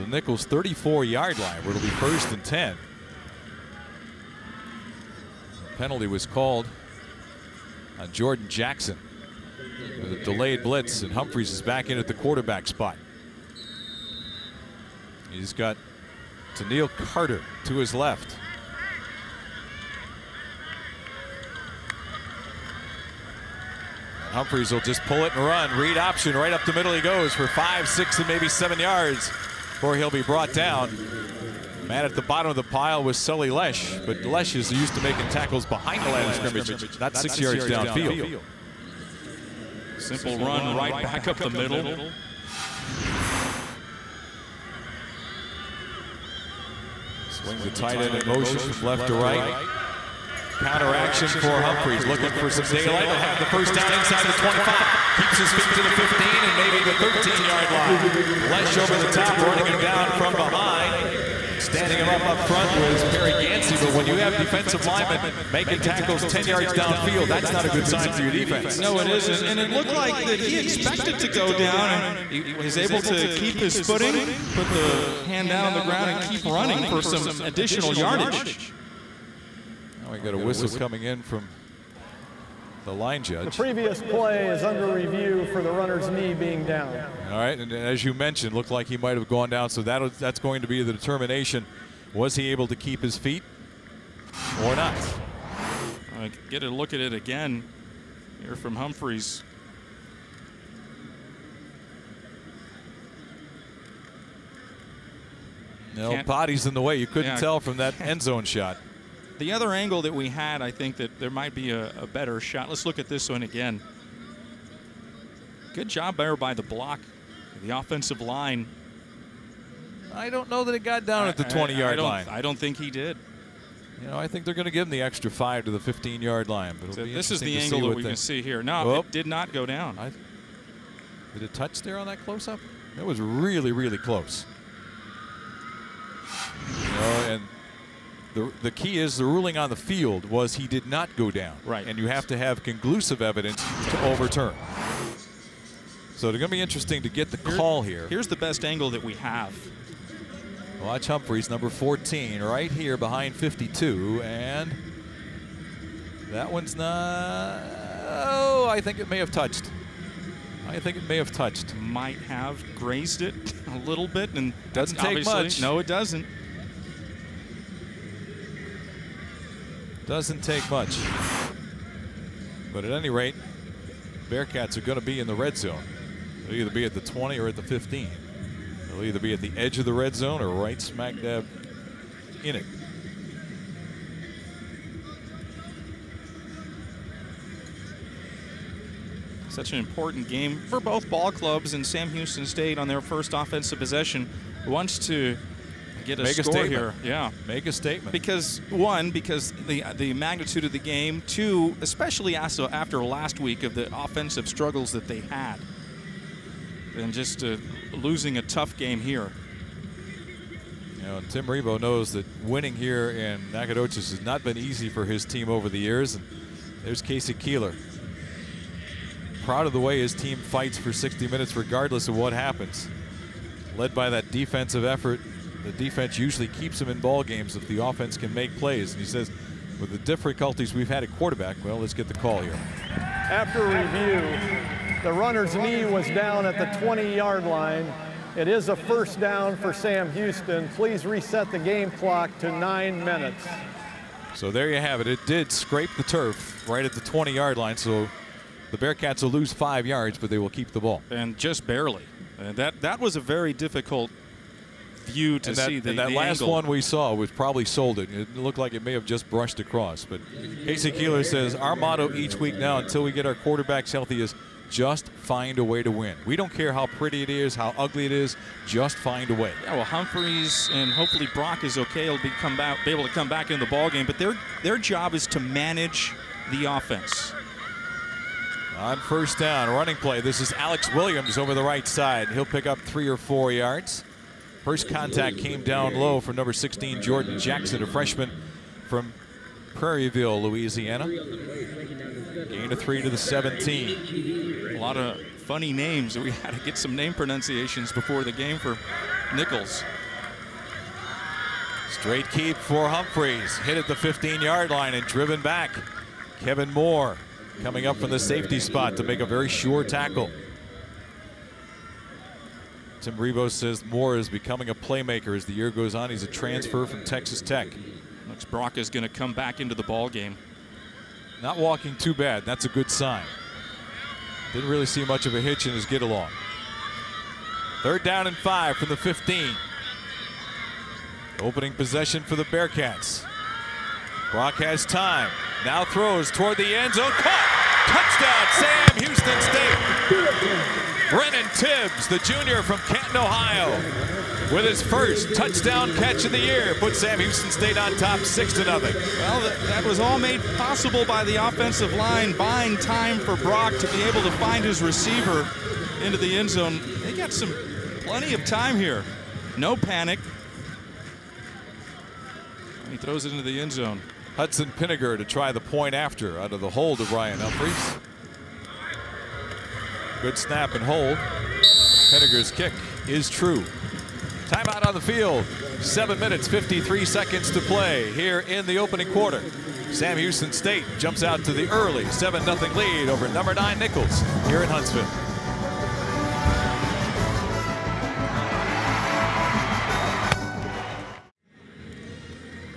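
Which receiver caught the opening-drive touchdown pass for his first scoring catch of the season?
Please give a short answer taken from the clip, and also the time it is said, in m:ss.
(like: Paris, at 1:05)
Brennan Tibbs, at 5:41.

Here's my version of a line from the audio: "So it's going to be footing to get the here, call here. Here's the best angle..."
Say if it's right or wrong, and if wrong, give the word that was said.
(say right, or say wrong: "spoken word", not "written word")
wrong: "interesting", not "footing".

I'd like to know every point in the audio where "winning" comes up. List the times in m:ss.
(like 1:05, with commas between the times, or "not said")
3:32.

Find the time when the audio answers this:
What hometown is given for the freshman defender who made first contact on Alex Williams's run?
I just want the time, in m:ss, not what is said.
4:49.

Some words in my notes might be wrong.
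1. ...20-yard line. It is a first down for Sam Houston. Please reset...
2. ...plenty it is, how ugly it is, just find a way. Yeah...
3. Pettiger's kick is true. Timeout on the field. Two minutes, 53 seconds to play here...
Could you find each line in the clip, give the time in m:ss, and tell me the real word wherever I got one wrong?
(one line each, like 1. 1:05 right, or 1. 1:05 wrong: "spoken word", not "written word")
1. 3:56 right
2. 4:26 wrong: "pretty", not "plenty"
3. 6:12 wrong: "Seven", not "Two".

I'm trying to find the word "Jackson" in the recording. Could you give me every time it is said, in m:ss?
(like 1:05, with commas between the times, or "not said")
0:08, 4:47.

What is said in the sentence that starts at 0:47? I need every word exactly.
Swing the tight end in motion from left to right.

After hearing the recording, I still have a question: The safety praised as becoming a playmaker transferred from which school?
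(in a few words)
Texas Tech.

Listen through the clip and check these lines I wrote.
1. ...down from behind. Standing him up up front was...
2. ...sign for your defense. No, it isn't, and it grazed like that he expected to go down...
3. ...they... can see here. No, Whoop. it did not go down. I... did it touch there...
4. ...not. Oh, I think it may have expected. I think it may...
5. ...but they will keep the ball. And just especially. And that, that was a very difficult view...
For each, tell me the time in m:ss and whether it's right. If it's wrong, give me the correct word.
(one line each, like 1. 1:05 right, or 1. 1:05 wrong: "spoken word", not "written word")
1. 0:59 right
2. 1:07 wrong: "looked", not "grazed"
3. 2:08 right
4. 2:36 wrong: "touched", not "expected"
5. 4:10 wrong: "barely", not "especially".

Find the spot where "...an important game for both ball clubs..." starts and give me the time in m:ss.
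3:09.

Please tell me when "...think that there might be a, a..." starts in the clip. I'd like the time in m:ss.
1:50.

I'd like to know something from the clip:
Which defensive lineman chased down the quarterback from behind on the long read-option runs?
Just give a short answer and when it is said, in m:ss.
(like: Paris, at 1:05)
Sully Laiche, at 0:33.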